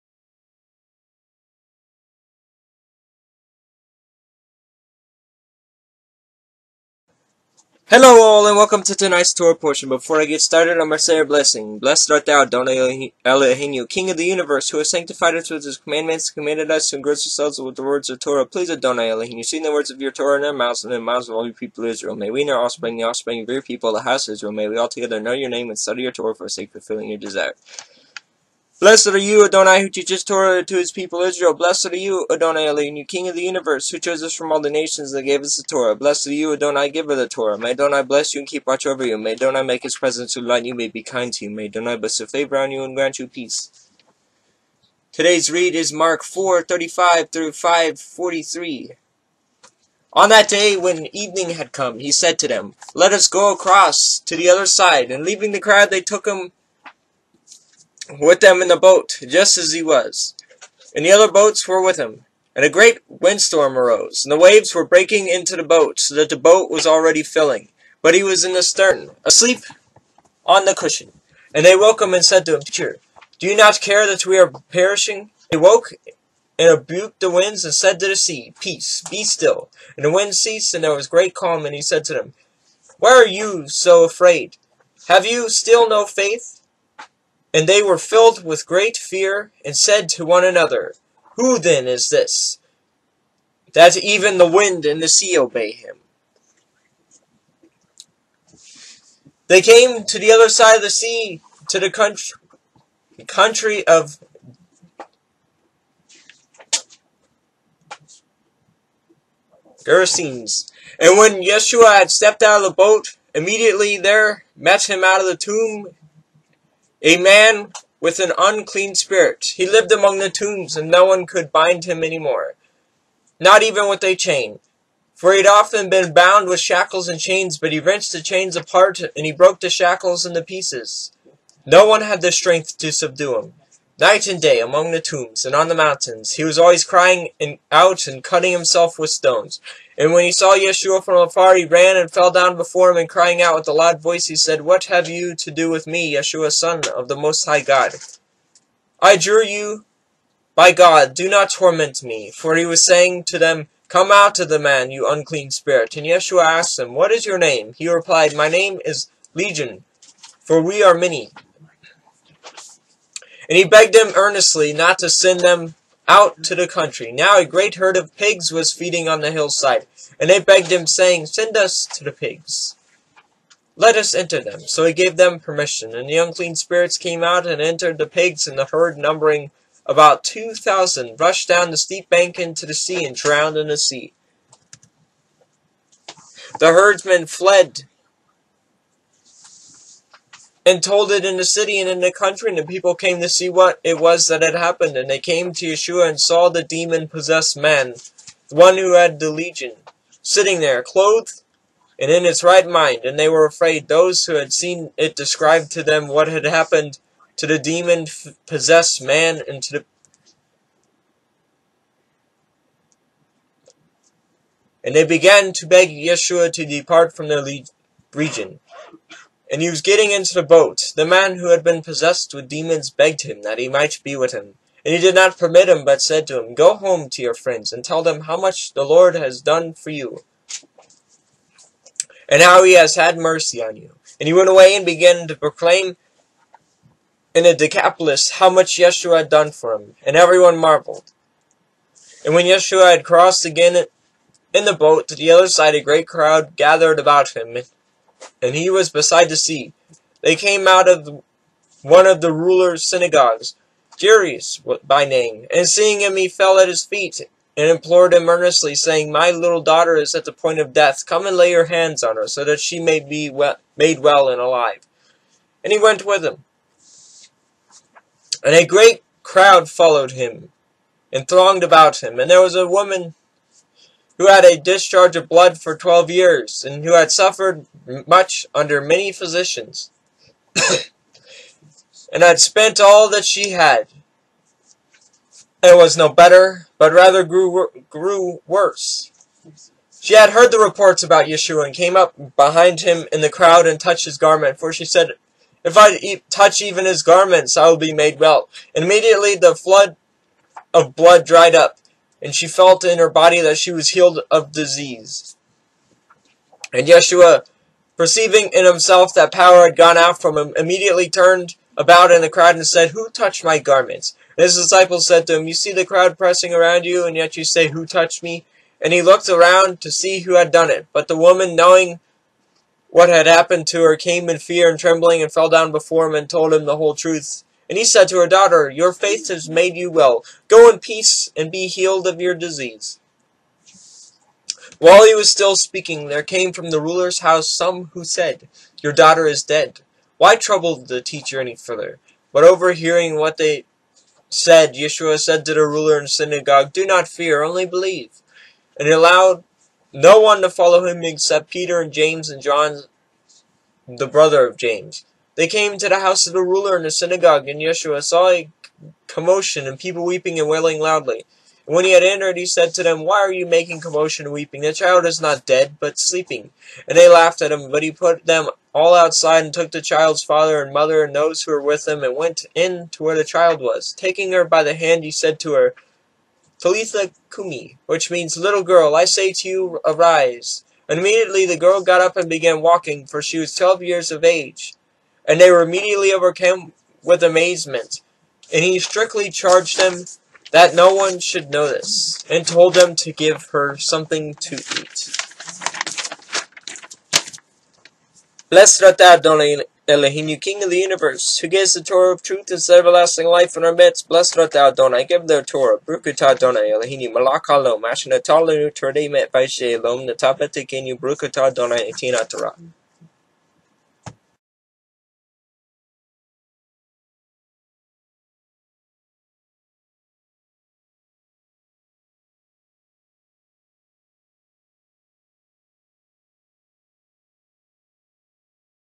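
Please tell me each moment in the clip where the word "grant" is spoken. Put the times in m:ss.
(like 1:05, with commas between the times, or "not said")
0:42.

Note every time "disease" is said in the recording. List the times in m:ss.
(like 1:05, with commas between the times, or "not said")
5:04, 5:32.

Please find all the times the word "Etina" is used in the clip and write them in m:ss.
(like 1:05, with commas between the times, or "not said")
6:51.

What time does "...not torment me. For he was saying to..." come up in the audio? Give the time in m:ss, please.
2:31.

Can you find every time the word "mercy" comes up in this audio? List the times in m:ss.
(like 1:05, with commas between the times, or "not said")
3:53.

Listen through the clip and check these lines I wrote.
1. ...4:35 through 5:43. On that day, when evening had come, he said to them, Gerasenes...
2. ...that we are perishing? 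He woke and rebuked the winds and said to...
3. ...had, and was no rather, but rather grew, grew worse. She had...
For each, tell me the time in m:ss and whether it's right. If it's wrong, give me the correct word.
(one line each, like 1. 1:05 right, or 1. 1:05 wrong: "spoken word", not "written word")
1. 0:46 wrong: "Let", not "Gerasenes"
2. 1:14 right
3. 4:43 wrong: "better", not "rather".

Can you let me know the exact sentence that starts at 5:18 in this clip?
And he looked around to see who had done it.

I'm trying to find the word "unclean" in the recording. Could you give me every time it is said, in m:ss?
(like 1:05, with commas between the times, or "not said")
1:58, 2:35, 2:56.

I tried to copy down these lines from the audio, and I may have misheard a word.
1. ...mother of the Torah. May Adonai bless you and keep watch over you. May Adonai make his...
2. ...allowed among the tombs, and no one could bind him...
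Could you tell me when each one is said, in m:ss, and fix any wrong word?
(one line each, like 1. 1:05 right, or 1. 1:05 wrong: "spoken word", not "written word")
1. 0:36 wrong: "giver", not "mother"
2. 1:59 wrong: "lived", not "allowed".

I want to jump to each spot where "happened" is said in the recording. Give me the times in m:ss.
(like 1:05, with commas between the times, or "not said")
3:14, 3:26, 5:23.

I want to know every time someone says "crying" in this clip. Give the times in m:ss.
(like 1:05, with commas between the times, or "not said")
2:16, 2:23.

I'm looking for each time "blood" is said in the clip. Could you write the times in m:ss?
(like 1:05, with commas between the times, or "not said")
4:35, 5:00.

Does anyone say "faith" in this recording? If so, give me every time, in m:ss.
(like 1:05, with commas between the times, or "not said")
1:26, 5:28.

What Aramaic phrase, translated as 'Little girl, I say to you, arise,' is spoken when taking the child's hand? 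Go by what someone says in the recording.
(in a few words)
Talitha Kumi.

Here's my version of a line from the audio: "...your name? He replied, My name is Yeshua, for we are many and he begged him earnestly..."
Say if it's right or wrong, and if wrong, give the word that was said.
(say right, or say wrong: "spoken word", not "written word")
wrong: "Legion", not "Yeshua".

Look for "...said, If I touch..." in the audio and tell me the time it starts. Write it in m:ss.
4:54.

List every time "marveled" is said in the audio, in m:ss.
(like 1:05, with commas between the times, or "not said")
4:00.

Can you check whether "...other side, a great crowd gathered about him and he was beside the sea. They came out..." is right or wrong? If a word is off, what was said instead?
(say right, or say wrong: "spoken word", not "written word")
right.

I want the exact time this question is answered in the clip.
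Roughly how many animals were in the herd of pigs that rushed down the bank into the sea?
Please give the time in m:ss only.
3:00.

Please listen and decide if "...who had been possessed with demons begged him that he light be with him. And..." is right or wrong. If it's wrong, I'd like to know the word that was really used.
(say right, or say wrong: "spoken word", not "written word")
wrong: "might", not "light".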